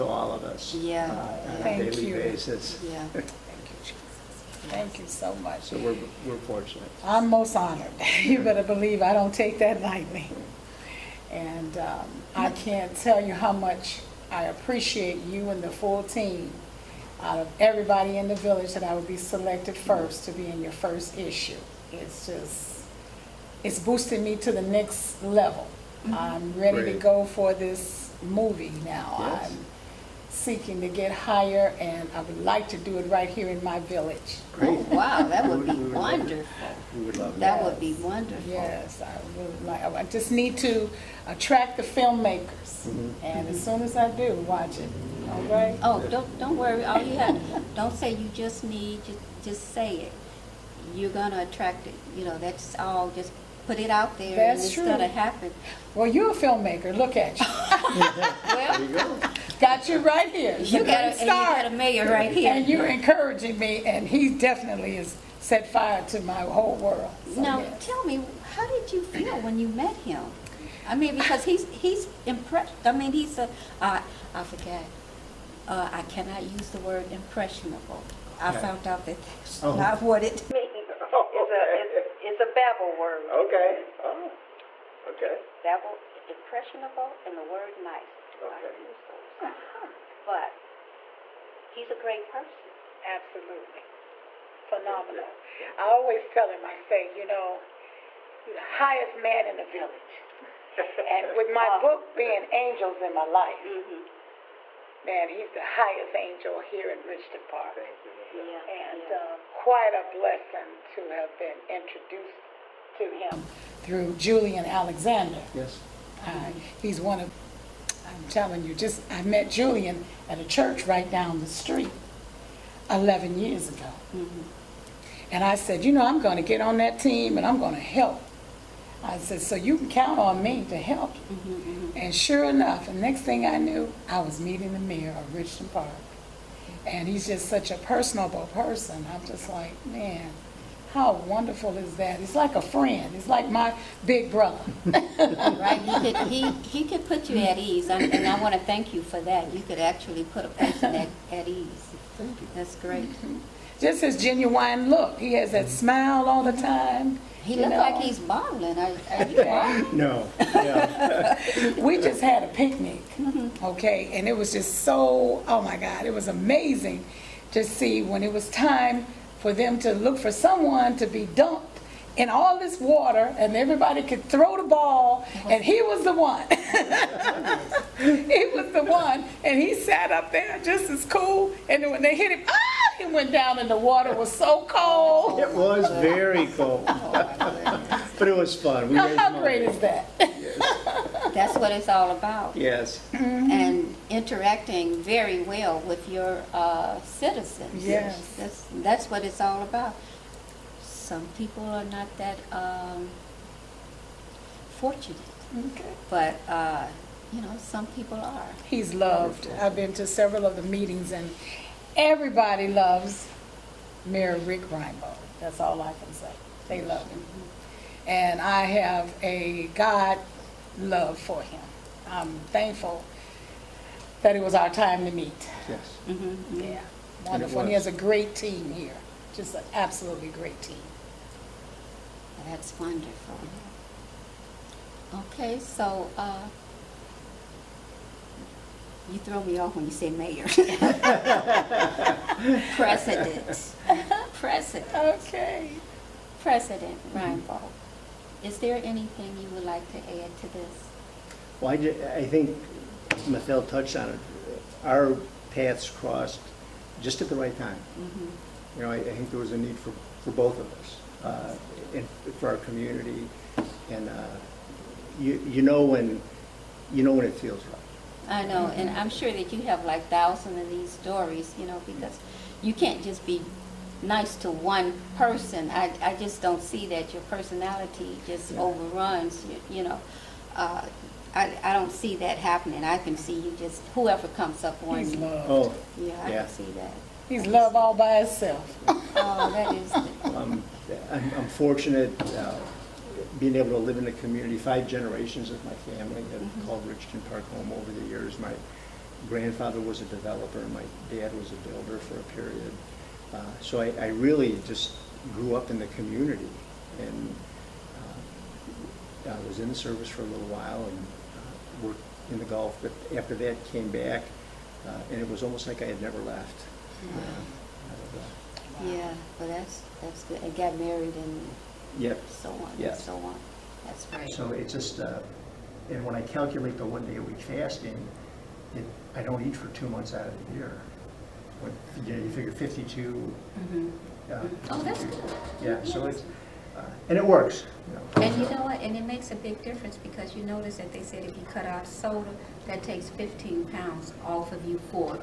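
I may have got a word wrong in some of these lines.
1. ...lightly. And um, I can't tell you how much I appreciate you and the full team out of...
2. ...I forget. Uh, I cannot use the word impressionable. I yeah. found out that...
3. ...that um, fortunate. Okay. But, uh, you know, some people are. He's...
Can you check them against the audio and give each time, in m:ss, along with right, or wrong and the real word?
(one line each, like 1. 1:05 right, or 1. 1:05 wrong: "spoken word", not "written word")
1. 0:09 right
2. 1:14 right
3. 3:22 right.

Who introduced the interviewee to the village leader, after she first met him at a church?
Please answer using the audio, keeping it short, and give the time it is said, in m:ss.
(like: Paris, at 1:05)
Julian Alexander, at 1:54.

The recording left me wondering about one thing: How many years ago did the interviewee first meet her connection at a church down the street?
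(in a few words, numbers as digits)
11.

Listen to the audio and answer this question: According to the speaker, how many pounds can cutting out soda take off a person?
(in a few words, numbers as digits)
15.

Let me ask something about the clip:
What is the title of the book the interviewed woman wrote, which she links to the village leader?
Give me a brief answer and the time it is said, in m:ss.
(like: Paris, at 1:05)
Angels in My Life, at 1:42.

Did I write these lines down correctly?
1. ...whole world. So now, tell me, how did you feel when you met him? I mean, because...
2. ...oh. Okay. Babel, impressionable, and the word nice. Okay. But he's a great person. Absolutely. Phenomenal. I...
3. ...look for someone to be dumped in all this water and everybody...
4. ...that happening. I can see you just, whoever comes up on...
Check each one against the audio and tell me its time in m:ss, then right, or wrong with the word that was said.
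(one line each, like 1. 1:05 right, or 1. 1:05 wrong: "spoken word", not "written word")
1. 1:06 right
2. 1:24 right
3. 2:49 right
4. 4:42 right.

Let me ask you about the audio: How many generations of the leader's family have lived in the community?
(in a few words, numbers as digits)
5.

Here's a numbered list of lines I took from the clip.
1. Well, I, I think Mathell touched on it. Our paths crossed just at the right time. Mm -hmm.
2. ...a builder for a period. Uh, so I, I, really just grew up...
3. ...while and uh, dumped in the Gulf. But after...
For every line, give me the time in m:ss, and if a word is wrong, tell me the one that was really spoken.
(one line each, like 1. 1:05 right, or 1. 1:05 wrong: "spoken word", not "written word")
1. 4:11 right
2. 5:01 right
3. 5:10 wrong: "worked", not "dumped".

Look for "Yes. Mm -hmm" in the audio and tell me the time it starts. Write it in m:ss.
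3:12.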